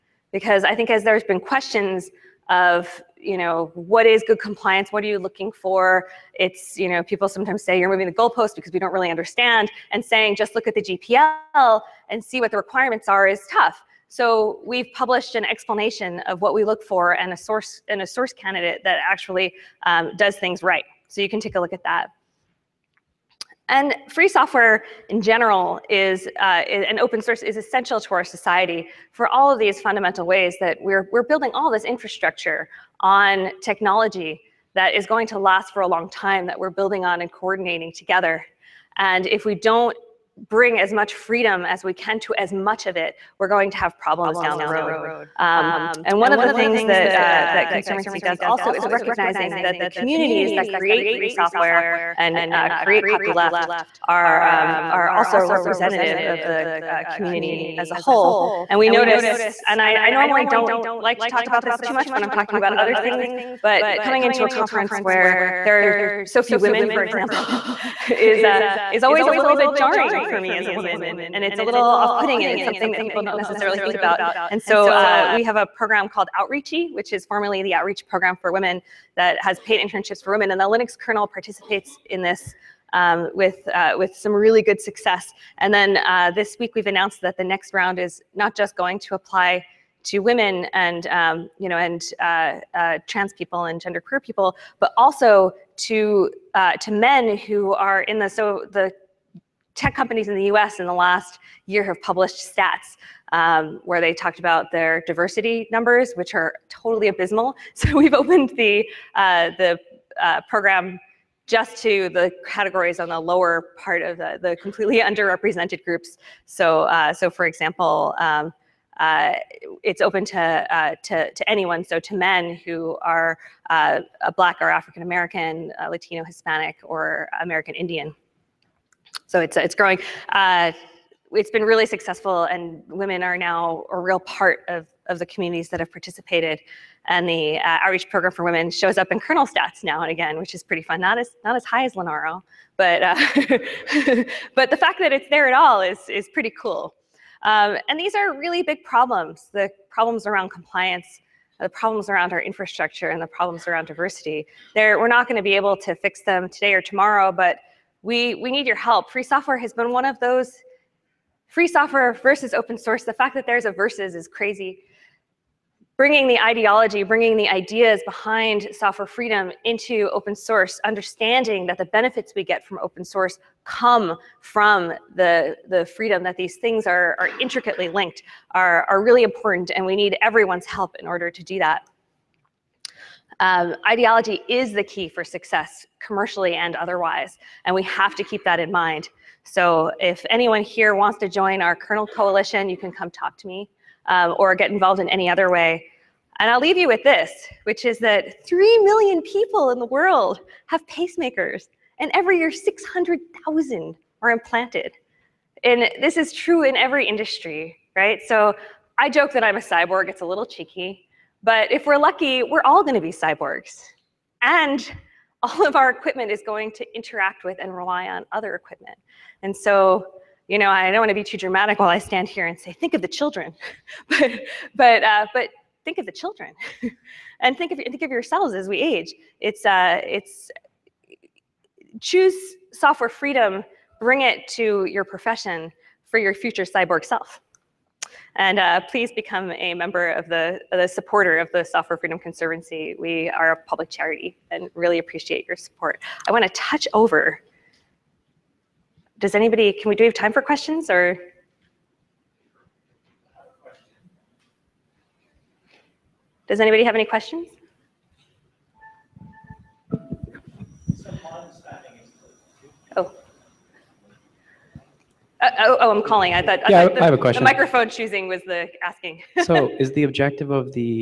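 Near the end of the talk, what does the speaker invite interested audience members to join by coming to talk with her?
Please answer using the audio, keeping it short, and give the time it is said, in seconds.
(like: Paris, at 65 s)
kernel coalition, at 191 s.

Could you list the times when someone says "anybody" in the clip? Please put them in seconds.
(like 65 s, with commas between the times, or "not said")
249 s, 256 s.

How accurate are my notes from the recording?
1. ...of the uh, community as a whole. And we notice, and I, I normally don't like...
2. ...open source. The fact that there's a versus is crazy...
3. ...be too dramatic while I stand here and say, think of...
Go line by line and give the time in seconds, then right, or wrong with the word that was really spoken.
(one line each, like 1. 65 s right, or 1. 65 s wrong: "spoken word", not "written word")
1. 56 s right
2. 162 s right
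3. 221 s right.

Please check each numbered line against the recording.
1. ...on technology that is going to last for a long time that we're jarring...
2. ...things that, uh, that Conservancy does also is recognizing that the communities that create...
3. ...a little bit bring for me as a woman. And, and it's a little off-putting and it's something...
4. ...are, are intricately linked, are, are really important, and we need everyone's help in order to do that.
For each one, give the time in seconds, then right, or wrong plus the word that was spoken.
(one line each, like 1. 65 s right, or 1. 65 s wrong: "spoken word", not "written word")
1. 33 s wrong: "building", not "jarring"
2. 46 s right
3. 69 s wrong: "jarring", not "bring"
4. 176 s right.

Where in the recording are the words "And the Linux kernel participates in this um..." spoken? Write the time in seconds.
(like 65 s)
80 s.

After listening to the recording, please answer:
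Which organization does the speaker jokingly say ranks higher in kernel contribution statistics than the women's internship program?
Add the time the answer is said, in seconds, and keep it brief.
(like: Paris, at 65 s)
Linaro, at 141 s.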